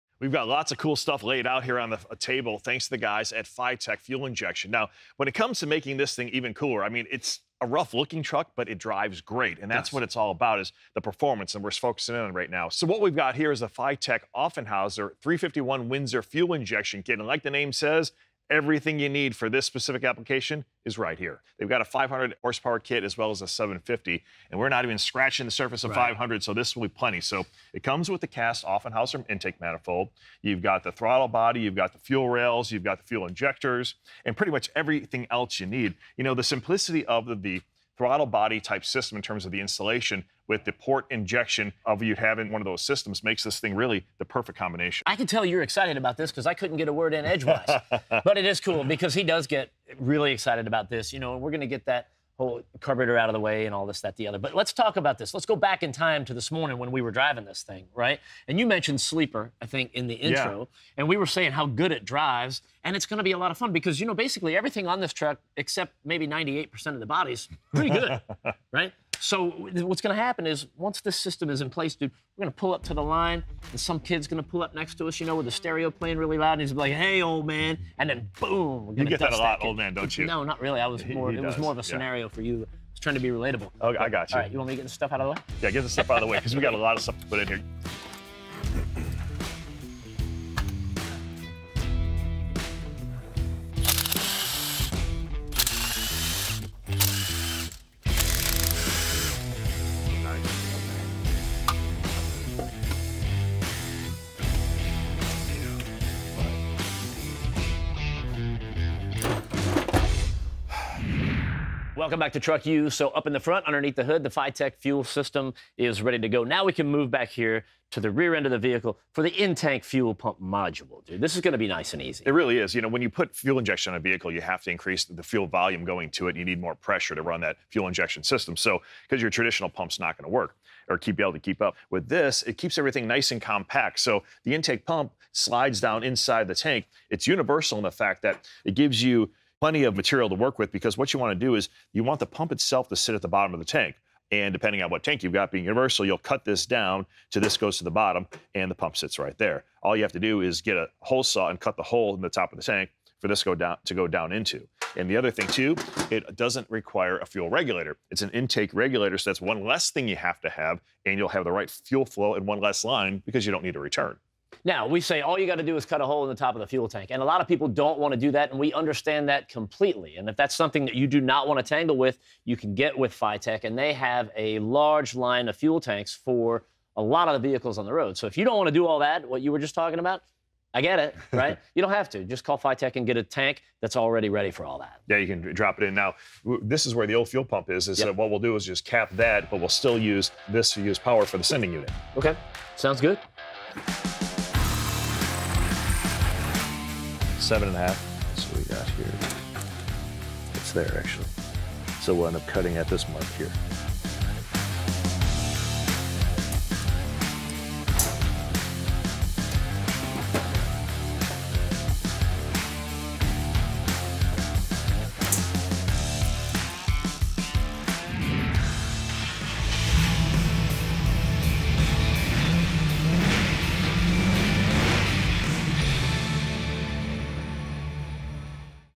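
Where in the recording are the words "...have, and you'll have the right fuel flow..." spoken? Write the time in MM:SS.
02:40.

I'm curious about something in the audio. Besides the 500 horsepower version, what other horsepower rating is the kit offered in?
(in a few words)
750.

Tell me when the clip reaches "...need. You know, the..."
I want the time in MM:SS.
00:35.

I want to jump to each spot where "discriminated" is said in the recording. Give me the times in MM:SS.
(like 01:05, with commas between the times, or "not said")
not said.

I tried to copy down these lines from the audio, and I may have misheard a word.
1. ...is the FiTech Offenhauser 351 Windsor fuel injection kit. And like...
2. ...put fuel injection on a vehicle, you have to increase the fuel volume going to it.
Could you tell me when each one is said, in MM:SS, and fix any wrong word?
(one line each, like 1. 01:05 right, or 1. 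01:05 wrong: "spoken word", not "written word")
1. 00:13 right
2. 02:03 right.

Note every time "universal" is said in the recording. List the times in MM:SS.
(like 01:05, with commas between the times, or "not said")
02:17, 02:25.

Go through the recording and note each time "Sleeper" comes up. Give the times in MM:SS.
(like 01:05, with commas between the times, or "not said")
00:59.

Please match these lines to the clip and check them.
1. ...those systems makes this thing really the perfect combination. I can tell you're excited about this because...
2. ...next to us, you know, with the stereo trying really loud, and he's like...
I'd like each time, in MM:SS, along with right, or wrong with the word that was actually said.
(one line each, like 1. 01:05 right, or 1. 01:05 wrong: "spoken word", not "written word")
1. 00:42 right
2. 01:14 wrong: "playing", not "trying".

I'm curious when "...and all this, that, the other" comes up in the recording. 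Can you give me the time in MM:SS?
00:53.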